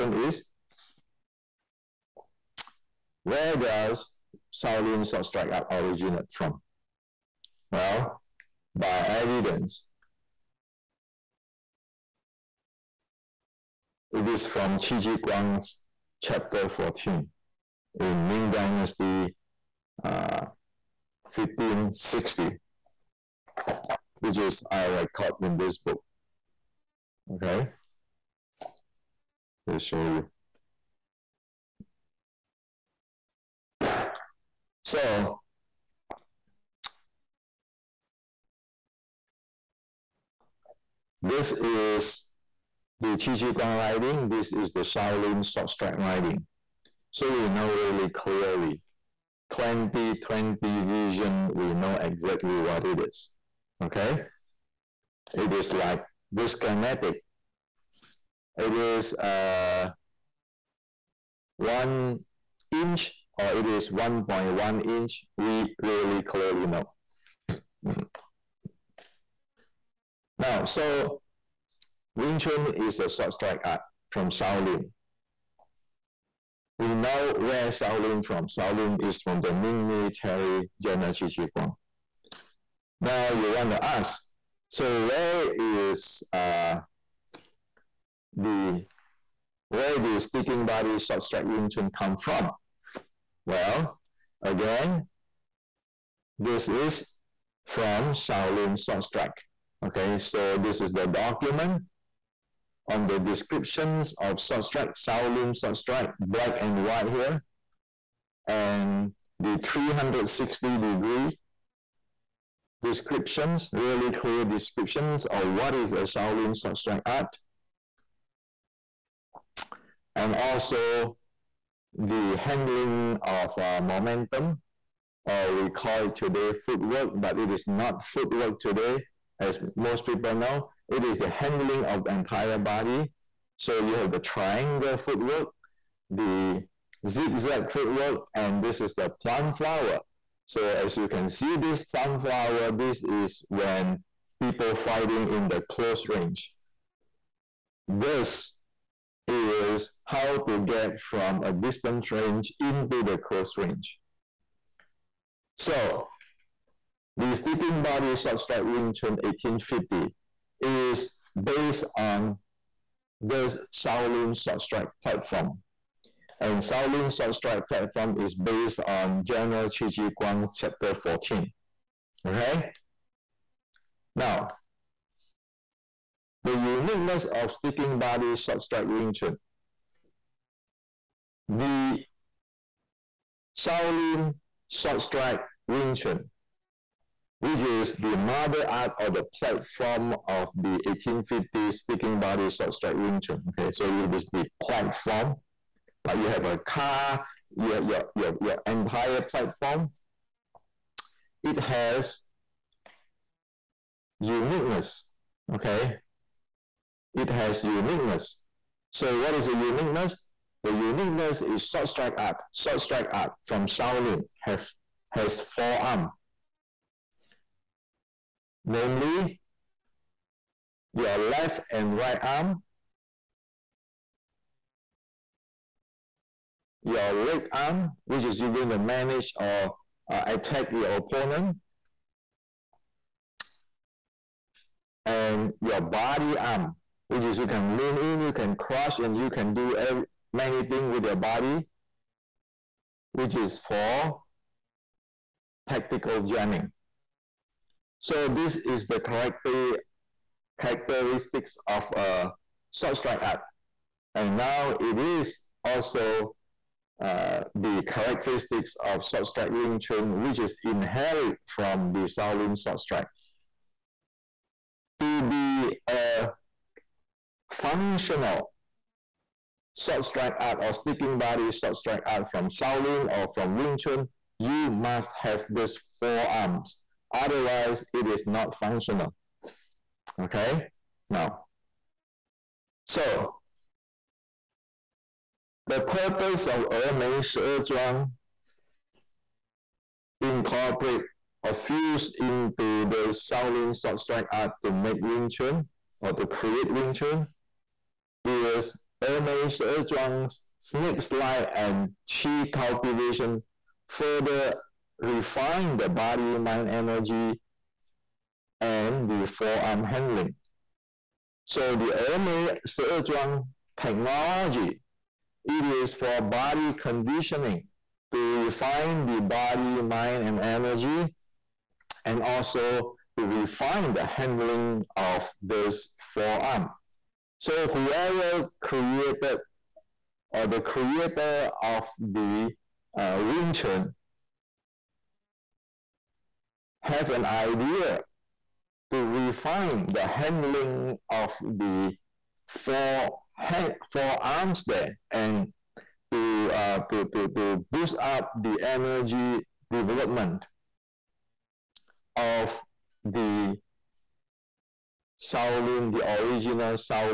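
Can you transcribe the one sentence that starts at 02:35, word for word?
So the sticking body short strike Wing Chun 1850 is based on the Shaolin short strike platform.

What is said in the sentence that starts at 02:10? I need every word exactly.
It is the handling of the entire body.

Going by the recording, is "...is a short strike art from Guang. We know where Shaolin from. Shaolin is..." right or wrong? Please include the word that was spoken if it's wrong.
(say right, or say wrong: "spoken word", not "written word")
wrong: "Shaolin", not "Guang".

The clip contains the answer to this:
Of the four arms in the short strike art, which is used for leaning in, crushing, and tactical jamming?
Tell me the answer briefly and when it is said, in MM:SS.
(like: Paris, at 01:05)
body arm, at 03:55.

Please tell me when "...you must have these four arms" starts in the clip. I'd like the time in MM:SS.
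04:34.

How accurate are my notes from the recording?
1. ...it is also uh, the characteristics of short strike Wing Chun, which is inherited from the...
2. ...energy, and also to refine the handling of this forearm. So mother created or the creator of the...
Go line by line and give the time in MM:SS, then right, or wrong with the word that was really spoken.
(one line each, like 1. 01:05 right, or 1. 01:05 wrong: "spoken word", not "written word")
1. 04:14 right
2. 05:20 wrong: "whoever", not "mother".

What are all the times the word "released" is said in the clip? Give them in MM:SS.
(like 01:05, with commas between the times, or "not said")
not said.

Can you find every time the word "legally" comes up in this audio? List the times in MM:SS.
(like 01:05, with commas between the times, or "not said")
not said.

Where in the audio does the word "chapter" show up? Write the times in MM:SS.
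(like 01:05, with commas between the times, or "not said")
00:16, 02:50.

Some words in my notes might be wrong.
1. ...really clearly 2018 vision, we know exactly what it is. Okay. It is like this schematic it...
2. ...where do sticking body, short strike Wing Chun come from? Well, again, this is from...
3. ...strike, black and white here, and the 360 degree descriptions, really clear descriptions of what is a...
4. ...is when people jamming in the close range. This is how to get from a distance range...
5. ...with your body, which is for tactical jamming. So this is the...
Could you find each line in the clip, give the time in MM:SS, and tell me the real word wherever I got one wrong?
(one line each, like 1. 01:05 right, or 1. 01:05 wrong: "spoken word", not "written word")
1. 00:47 wrong: "2020", not "2018"
2. 01:29 right
3. 01:45 right
4. 02:23 wrong: "fighting", not "jamming"
5. 04:00 right.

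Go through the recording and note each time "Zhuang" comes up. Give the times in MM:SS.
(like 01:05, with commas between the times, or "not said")
04:47, 04:59, 05:12.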